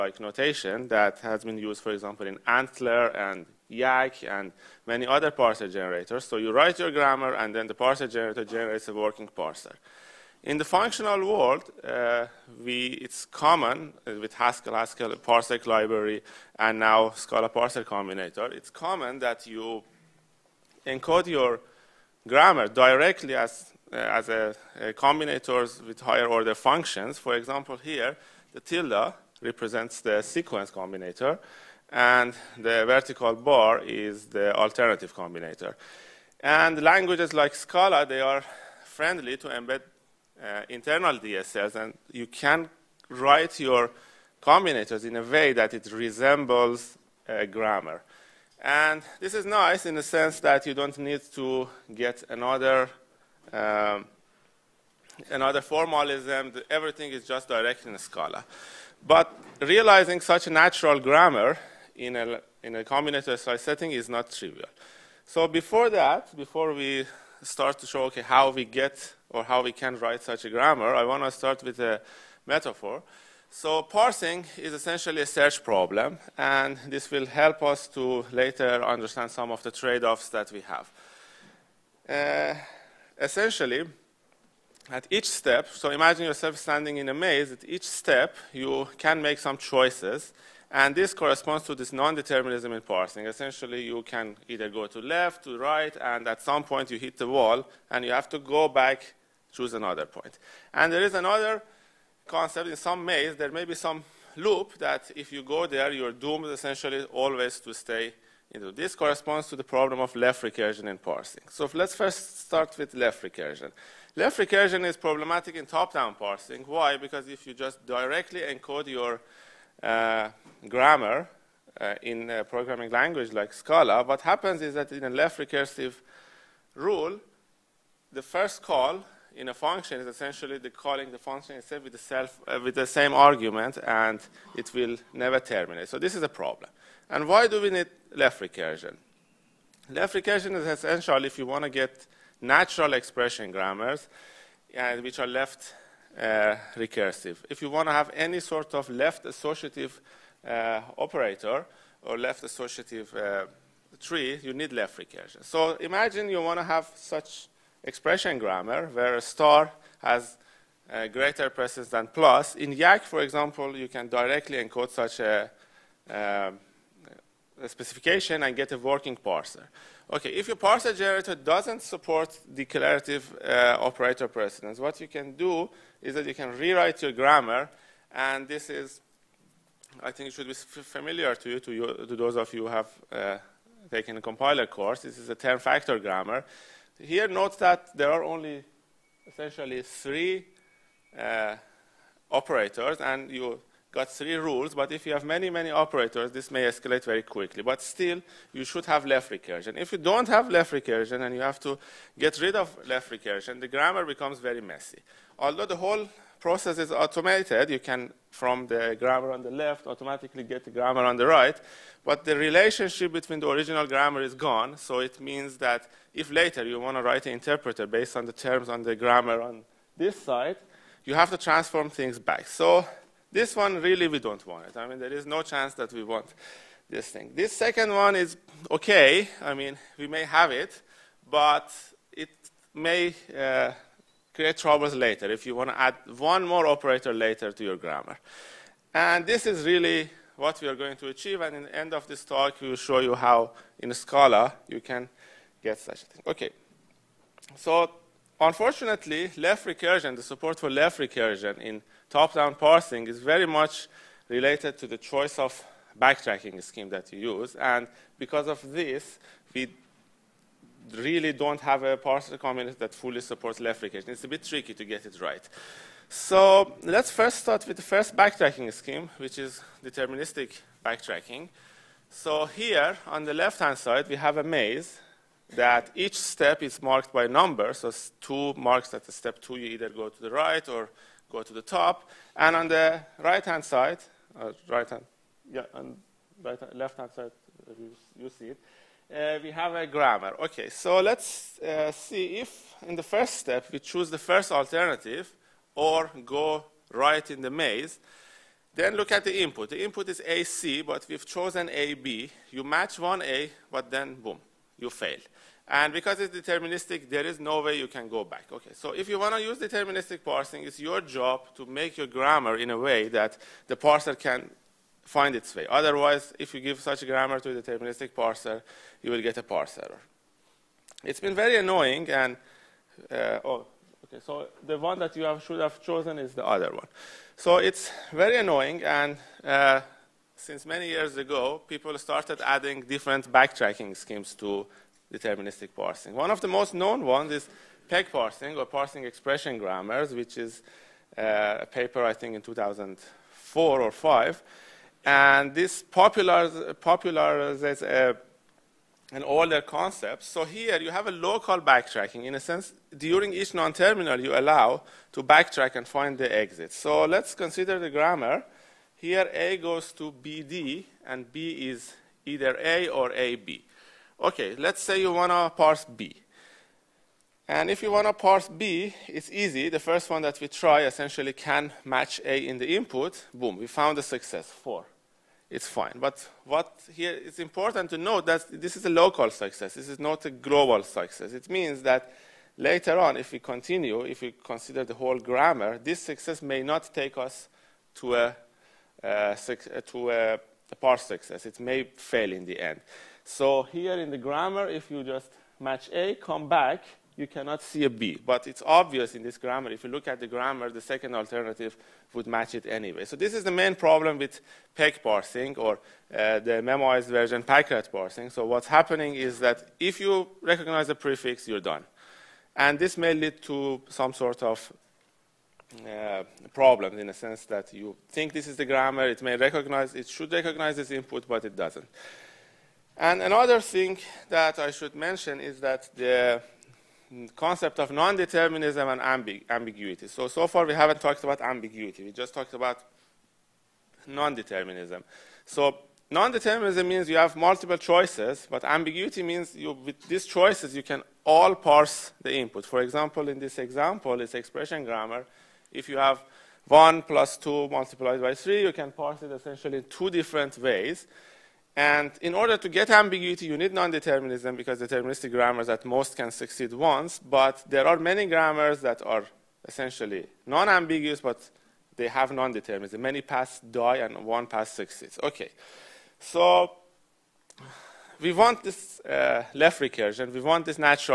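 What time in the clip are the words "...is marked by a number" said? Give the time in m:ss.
4:36.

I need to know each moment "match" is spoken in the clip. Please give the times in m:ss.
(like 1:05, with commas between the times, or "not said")
5:02, 6:11, 6:35, 6:42.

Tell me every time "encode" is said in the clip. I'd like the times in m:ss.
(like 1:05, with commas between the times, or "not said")
0:20, 1:58, 2:44.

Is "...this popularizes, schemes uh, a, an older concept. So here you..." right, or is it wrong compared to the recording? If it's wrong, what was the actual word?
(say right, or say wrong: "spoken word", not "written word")
wrong: "popularizes", not "schemes".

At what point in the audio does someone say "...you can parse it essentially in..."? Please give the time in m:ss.
7:28.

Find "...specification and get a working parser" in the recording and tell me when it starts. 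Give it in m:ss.
2:47.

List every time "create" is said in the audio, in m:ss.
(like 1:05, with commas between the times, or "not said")
3:54.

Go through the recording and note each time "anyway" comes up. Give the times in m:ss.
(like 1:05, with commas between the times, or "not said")
6:42.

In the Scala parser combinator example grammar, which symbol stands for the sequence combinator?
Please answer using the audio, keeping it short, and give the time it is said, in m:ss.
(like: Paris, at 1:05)
tilde, at 0:28.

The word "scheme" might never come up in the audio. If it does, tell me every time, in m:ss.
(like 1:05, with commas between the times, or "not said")
4:16, 4:28, 5:33.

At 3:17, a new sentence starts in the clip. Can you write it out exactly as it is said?
But still, you should have left recursion.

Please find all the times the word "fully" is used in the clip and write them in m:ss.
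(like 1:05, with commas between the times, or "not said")
4:22.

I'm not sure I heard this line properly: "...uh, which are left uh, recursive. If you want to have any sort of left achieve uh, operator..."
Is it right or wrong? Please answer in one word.
wrong.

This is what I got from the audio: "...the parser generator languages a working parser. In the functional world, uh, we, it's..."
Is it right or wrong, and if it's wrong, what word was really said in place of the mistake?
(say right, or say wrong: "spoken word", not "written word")
wrong: "generates", not "languages".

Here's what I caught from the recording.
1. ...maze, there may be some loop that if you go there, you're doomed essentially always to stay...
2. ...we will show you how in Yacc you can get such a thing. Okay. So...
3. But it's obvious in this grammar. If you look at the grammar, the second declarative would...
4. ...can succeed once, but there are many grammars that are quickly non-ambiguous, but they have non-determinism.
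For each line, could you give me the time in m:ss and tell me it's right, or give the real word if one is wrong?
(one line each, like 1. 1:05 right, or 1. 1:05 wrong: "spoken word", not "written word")
1. 1:43 right
2. 4:02 wrong: "Scala", not "Yacc"
3. 6:38 wrong: "alternative", not "declarative"
4. 7:36 wrong: "essentially", not "quickly".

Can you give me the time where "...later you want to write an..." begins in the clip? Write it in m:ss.
3:36.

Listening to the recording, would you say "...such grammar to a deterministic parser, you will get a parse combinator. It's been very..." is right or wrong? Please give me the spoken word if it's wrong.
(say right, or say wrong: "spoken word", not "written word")
wrong: "error", not "combinator".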